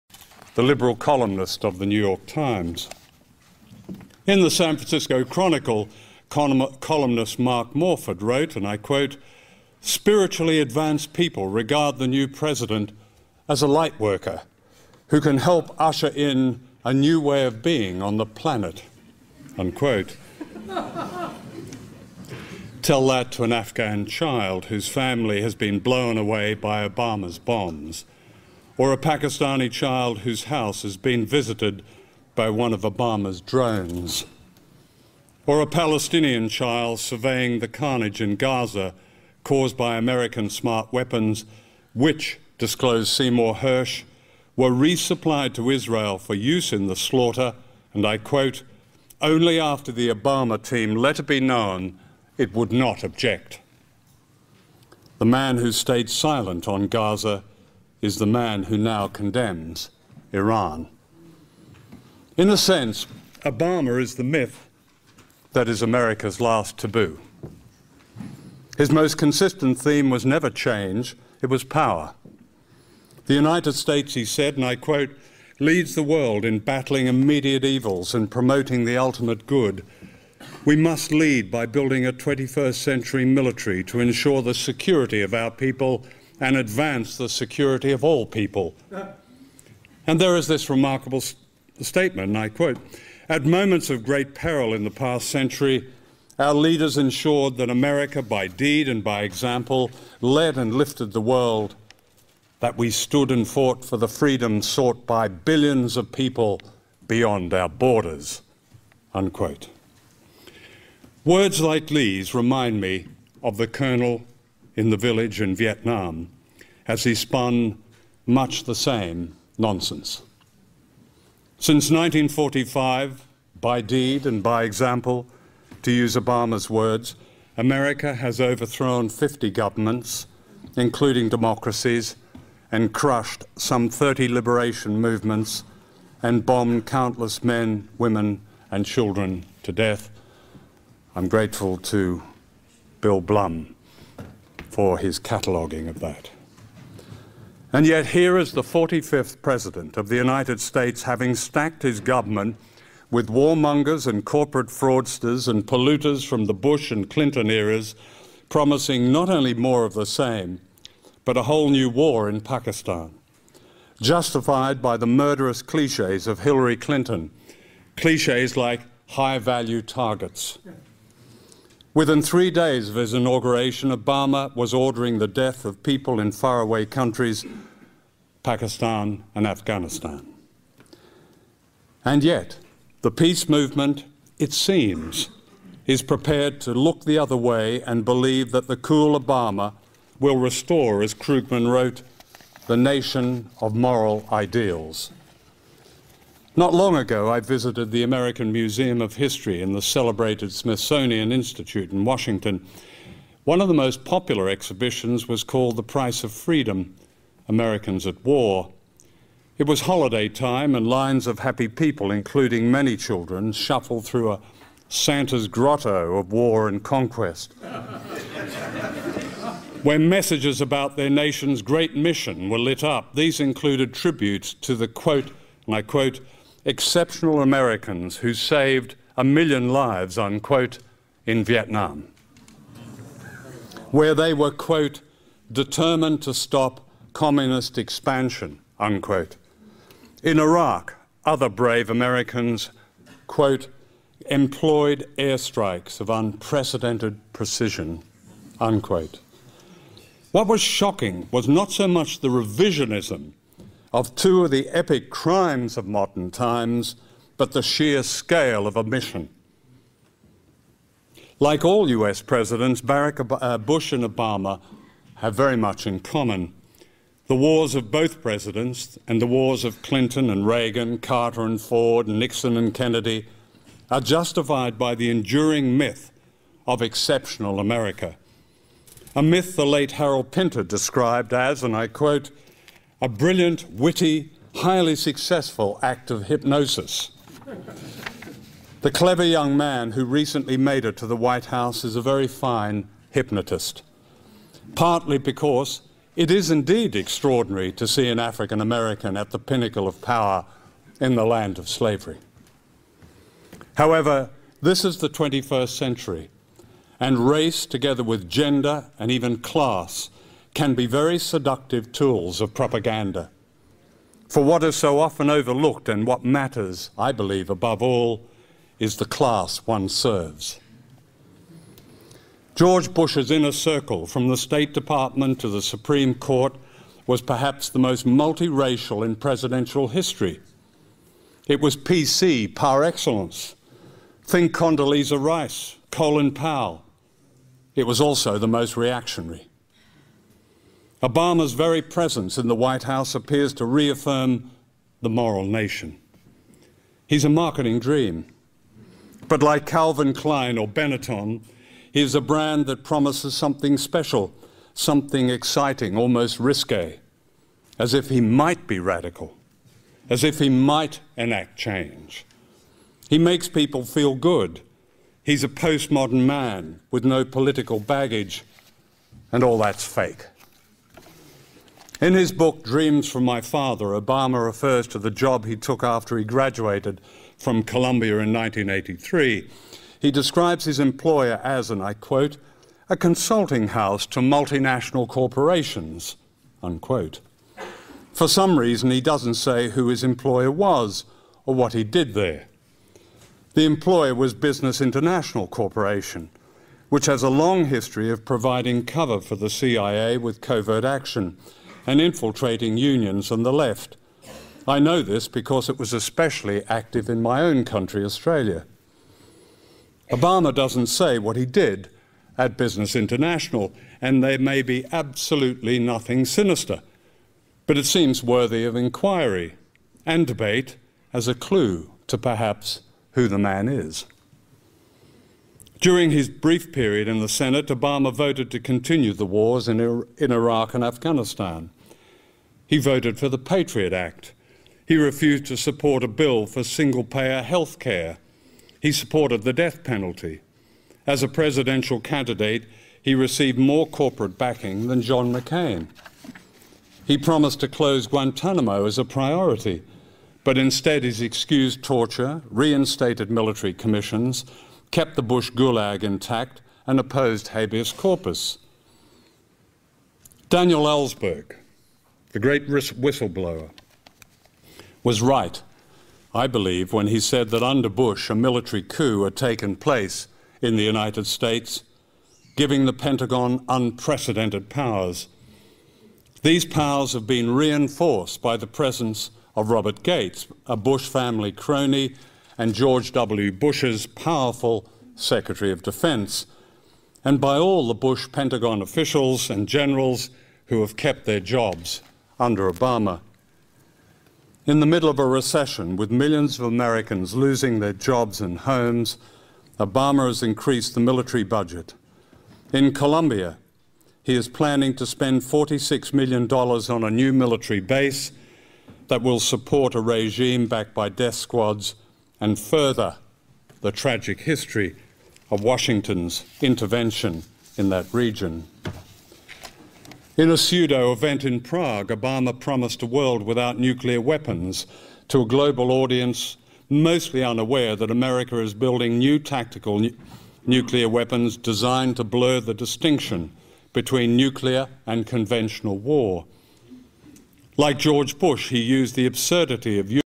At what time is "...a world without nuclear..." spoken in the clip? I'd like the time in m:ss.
8:43.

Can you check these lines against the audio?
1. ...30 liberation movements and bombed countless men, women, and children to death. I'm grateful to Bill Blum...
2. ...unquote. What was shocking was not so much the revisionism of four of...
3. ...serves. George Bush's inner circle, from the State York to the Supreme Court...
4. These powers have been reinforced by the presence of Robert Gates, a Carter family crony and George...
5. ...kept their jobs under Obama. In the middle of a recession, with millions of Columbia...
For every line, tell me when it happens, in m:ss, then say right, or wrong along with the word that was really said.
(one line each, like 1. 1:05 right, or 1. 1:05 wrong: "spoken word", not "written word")
1. 2:13 right
2. 4:08 wrong: "two", not "four"
3. 5:19 wrong: "Department", not "York"
4. 7:56 wrong: "Bush", not "Carter"
5. 8:10 wrong: "Americans", not "Columbia".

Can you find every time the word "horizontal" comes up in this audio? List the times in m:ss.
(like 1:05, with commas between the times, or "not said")
not said.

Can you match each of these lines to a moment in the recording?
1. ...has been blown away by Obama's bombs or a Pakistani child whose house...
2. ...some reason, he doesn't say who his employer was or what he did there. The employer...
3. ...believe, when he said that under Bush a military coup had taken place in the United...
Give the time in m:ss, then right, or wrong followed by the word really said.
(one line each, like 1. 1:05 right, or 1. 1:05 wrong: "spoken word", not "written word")
1. 0:25 right
2. 6:28 right
3. 7:46 right.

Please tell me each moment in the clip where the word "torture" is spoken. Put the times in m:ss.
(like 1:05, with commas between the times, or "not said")
7:31.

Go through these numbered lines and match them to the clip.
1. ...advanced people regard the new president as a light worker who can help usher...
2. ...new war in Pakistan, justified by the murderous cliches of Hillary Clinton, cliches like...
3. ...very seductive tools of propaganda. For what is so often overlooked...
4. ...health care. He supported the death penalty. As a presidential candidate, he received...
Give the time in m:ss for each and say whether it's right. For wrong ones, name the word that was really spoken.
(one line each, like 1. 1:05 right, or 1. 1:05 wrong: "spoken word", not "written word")
1. 0:10 right
2. 2:41 right
3. 5:10 right
4. 7:17 right.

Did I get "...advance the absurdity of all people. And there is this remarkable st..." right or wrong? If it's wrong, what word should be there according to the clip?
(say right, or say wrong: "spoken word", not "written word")
wrong: "security", not "absurdity".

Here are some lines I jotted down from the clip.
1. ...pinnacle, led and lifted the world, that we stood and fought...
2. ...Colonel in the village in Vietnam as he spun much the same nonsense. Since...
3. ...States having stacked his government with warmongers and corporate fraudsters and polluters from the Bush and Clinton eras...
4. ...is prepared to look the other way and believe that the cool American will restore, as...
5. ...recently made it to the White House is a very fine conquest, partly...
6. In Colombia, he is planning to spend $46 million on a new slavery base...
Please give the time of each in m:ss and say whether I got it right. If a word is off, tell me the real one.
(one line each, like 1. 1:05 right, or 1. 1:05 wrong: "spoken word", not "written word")
1. 1:39 wrong: "example", not "pinnacle"
2. 1:53 right
3. 2:30 right
4. 3:05 wrong: "Obama", not "American"
5. 4:50 wrong: "hypnotist", not "conquest"
6. 8:22 wrong: "military", not "slavery".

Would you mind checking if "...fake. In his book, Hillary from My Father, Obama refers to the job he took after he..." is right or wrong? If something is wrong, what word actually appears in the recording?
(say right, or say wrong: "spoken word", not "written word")
wrong: "Dreams", not "Hillary".